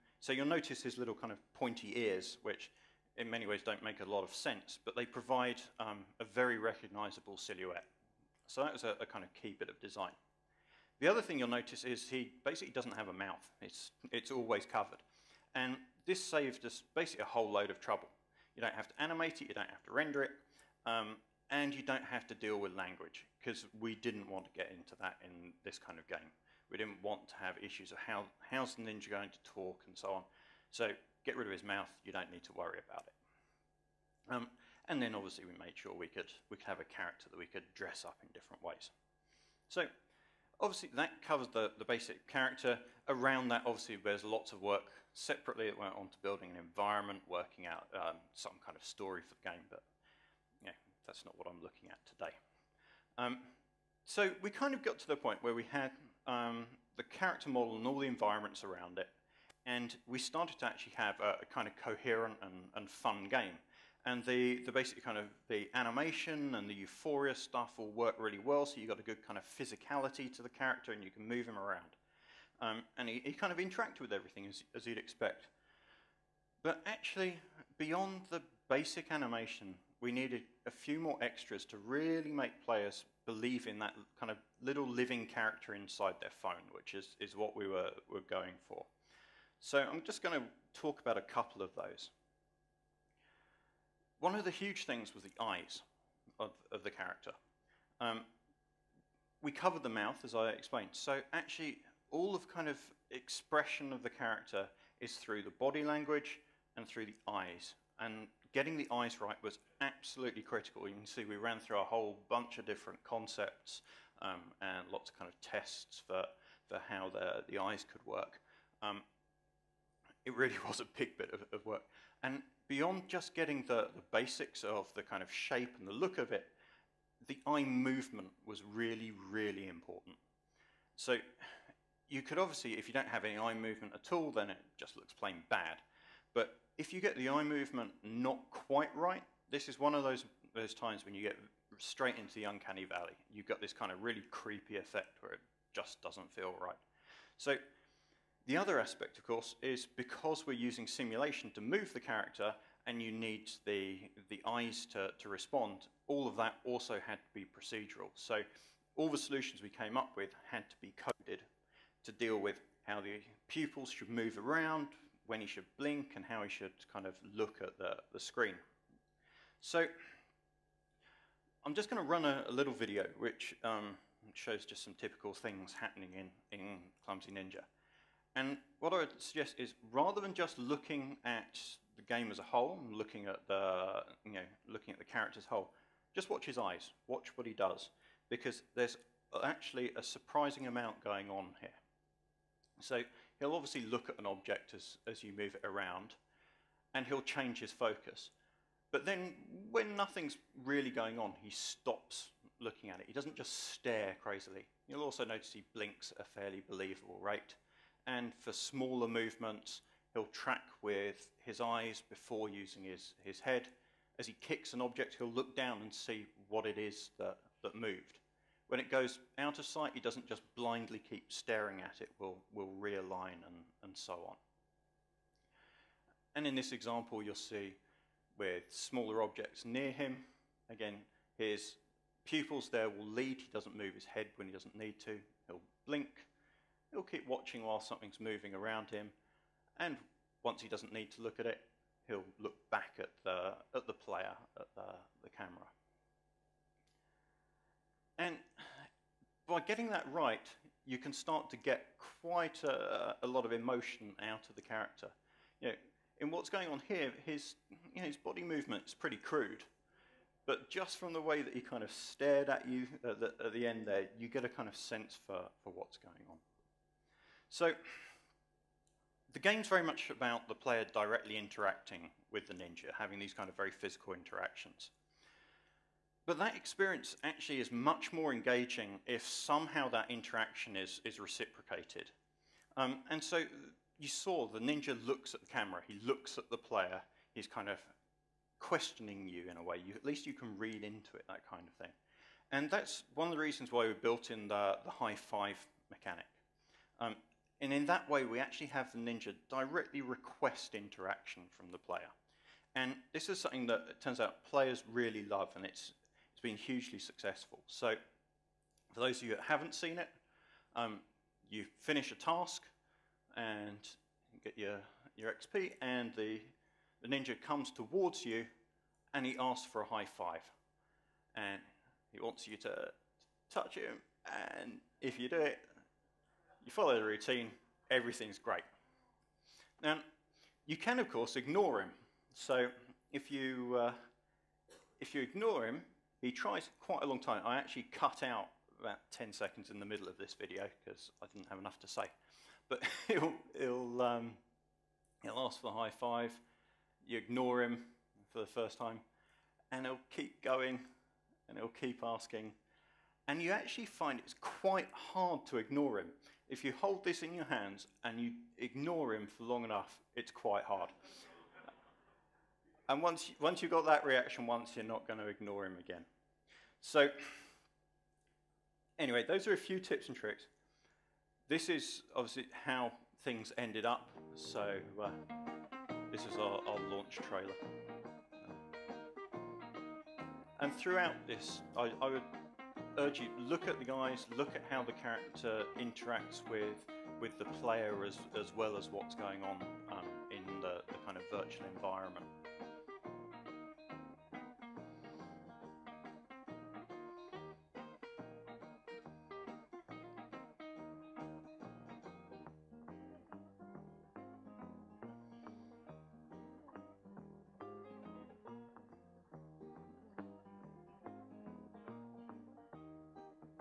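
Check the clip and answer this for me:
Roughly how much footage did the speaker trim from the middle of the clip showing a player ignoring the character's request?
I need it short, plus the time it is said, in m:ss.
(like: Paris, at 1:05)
About 10 seconds, at 5:39.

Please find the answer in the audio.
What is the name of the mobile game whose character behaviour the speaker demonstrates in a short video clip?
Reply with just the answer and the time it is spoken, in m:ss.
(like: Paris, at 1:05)
Clumsy Ninja, at 2:57.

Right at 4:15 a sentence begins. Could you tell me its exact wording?
You know, in what's going on here, his, you know, his body movement is pretty crude.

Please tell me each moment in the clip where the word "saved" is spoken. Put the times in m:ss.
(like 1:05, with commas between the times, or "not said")
0:16.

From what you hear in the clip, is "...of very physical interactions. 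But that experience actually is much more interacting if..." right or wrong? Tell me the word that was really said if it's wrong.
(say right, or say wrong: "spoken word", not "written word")
wrong: "engaging", not "interacting".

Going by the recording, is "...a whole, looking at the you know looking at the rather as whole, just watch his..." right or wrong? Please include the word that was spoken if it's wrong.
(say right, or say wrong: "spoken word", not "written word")
wrong: "character", not "rather".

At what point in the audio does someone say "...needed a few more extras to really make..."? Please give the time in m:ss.
1:20.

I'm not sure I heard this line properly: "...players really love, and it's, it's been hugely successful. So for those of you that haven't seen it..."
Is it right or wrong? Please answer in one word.
right.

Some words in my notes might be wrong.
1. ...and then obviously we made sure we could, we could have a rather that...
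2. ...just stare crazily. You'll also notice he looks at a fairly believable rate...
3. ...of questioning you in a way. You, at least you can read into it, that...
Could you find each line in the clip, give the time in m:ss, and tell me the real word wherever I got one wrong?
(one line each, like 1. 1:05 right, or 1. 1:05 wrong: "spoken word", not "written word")
1. 0:34 wrong: "character", not "rather"
2. 3:23 wrong: "blinks", not "looks"
3. 4:47 right.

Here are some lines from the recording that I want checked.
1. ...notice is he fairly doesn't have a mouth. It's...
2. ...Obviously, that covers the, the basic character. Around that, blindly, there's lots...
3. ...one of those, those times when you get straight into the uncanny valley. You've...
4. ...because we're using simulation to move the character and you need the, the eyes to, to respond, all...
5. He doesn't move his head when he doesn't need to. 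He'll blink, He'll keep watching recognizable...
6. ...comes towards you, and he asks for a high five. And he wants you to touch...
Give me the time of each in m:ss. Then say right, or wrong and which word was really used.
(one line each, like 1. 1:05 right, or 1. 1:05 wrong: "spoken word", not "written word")
1. 0:11 wrong: "basically", not "fairly"
2. 0:40 wrong: "obviously", not "blindly"
3. 2:19 right
4. 2:29 right
5. 3:53 wrong: "while", not "recognizable"
6. 5:17 right.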